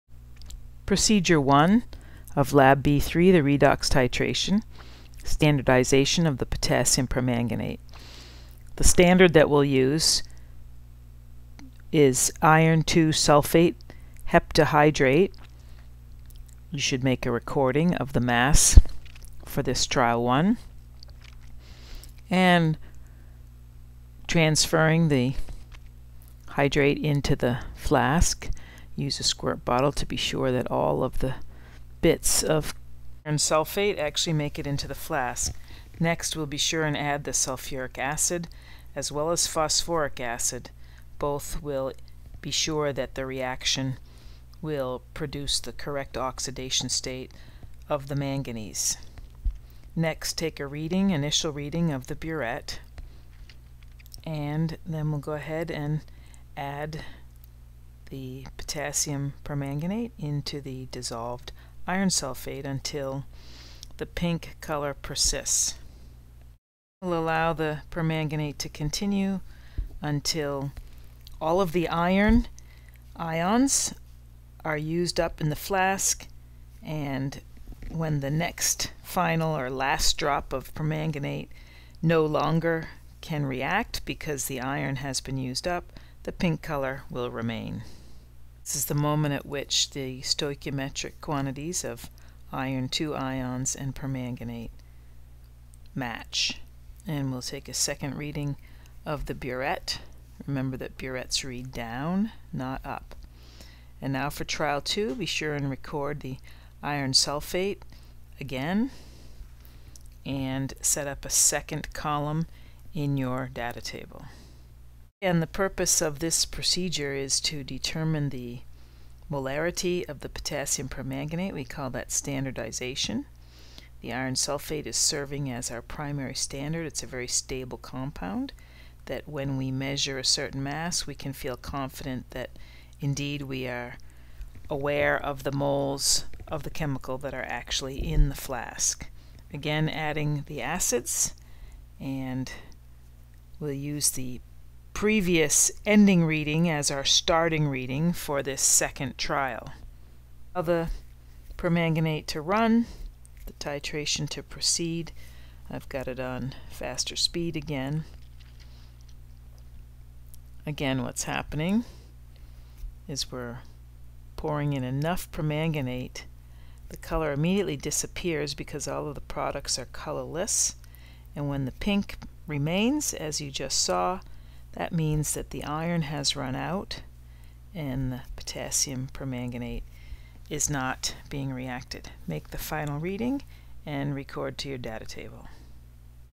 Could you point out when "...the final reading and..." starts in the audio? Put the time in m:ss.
3:02.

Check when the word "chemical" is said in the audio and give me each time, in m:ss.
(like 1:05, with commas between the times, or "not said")
2:16.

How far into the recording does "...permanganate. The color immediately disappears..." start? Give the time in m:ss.
2:45.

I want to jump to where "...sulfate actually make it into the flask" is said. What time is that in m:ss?
0:33.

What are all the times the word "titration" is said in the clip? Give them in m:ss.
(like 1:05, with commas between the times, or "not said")
0:03, 2:33.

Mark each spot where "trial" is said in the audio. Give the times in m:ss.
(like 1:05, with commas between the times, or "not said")
0:19, 1:44, 2:29.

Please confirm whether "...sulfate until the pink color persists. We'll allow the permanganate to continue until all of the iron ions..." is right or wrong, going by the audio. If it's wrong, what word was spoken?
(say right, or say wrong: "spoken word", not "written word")
right.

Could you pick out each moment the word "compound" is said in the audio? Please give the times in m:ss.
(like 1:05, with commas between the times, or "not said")
2:07.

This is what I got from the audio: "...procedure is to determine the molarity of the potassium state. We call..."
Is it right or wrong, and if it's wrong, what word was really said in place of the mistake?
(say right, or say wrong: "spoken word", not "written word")
wrong: "permanganate", not "state".